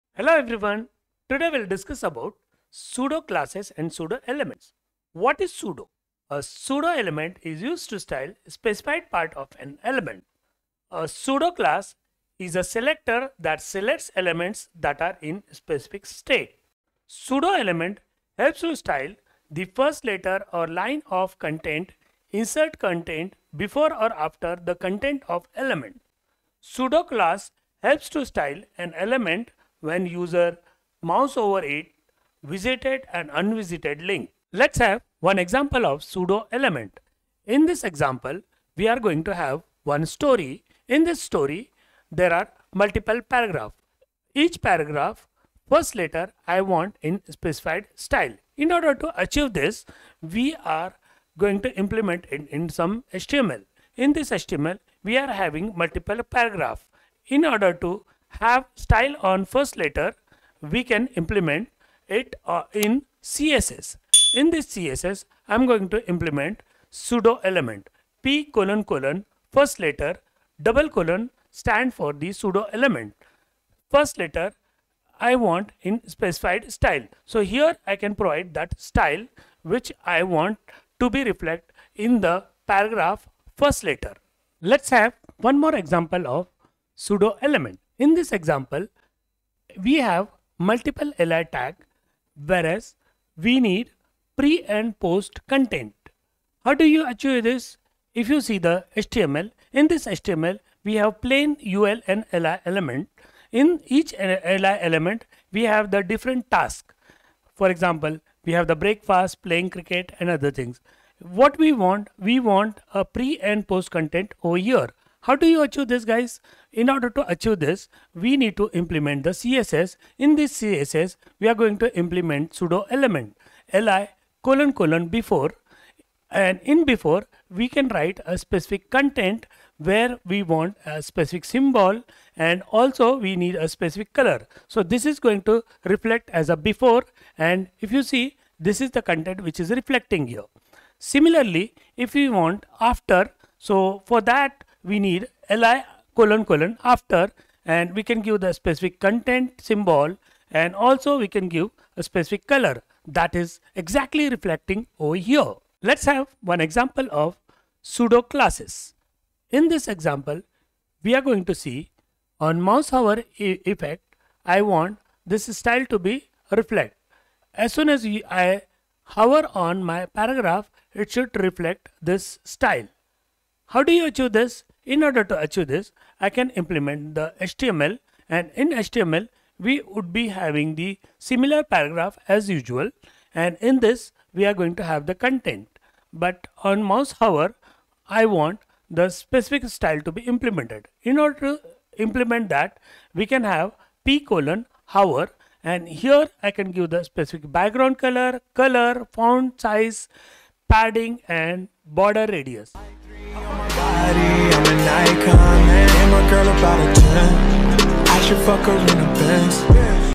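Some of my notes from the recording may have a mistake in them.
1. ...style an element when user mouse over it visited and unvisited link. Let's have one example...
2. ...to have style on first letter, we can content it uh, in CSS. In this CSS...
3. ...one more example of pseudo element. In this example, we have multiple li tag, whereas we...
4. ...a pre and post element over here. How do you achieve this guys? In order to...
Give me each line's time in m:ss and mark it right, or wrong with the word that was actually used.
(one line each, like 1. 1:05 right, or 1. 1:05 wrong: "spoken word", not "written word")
1. 0:28 right
2. 0:57 wrong: "implement", not "content"
3. 1:25 right
4. 1:52 wrong: "content", not "element".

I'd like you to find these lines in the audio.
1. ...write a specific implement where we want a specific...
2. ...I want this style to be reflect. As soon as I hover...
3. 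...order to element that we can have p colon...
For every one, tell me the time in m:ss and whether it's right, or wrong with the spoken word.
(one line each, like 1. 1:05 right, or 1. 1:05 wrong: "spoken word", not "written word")
1. 2:07 wrong: "content", not "implement"
2. 2:44 right
3. 3:11 wrong: "implement", not "element".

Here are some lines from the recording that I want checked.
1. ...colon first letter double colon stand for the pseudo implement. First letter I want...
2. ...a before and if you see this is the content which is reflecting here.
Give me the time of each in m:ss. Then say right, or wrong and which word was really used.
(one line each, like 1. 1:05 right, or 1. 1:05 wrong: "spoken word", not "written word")
1. 1:08 wrong: "element", not "implement"
2. 2:16 right.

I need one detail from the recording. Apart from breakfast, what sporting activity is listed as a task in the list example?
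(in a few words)
Playing cricket.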